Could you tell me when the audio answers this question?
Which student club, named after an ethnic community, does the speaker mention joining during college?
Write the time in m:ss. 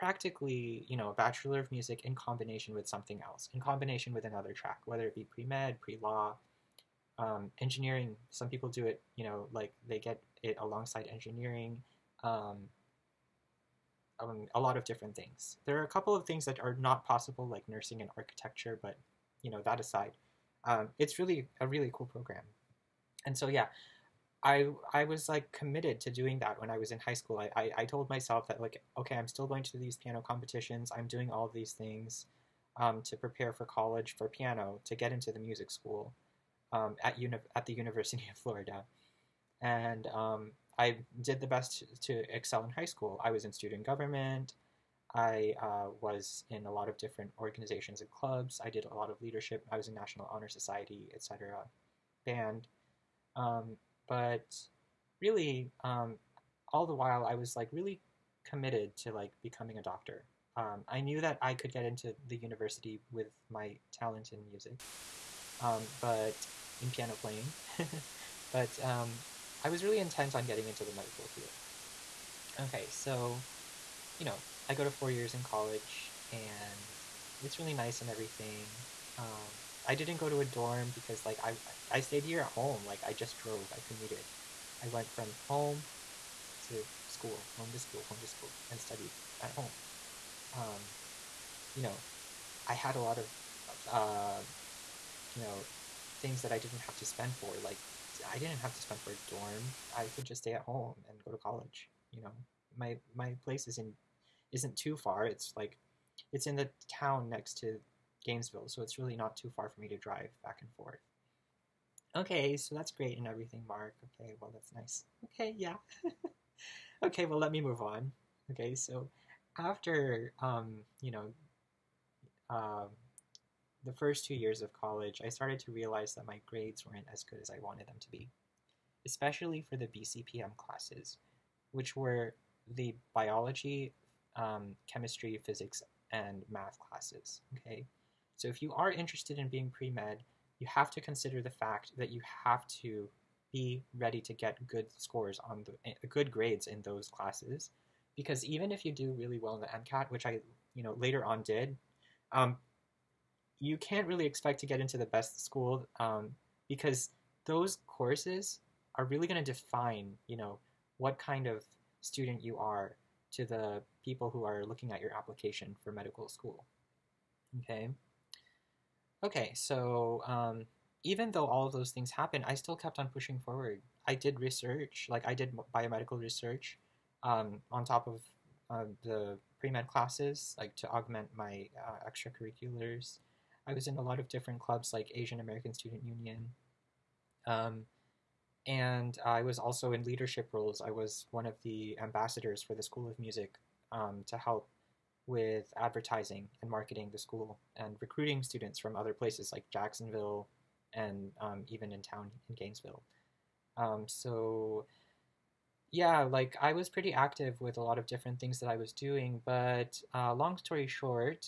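3:05.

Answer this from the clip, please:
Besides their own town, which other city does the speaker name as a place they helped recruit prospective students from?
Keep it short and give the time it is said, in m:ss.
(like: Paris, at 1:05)
Jacksonville, at 3:19.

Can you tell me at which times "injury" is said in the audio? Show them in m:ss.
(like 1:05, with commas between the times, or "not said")
not said.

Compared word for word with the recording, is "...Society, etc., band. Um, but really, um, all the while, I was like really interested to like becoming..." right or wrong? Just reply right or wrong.
wrong.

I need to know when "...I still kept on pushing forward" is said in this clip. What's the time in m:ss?
2:52.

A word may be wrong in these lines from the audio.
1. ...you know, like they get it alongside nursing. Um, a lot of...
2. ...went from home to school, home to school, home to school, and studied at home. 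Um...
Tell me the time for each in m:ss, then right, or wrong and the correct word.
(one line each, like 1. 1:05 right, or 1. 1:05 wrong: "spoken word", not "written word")
1. 0:09 wrong: "engineering", not "nursing"
2. 1:24 right.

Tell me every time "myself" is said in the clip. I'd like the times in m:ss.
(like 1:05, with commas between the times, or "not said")
0:28.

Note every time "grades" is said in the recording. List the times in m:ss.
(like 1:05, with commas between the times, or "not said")
2:06, 2:26.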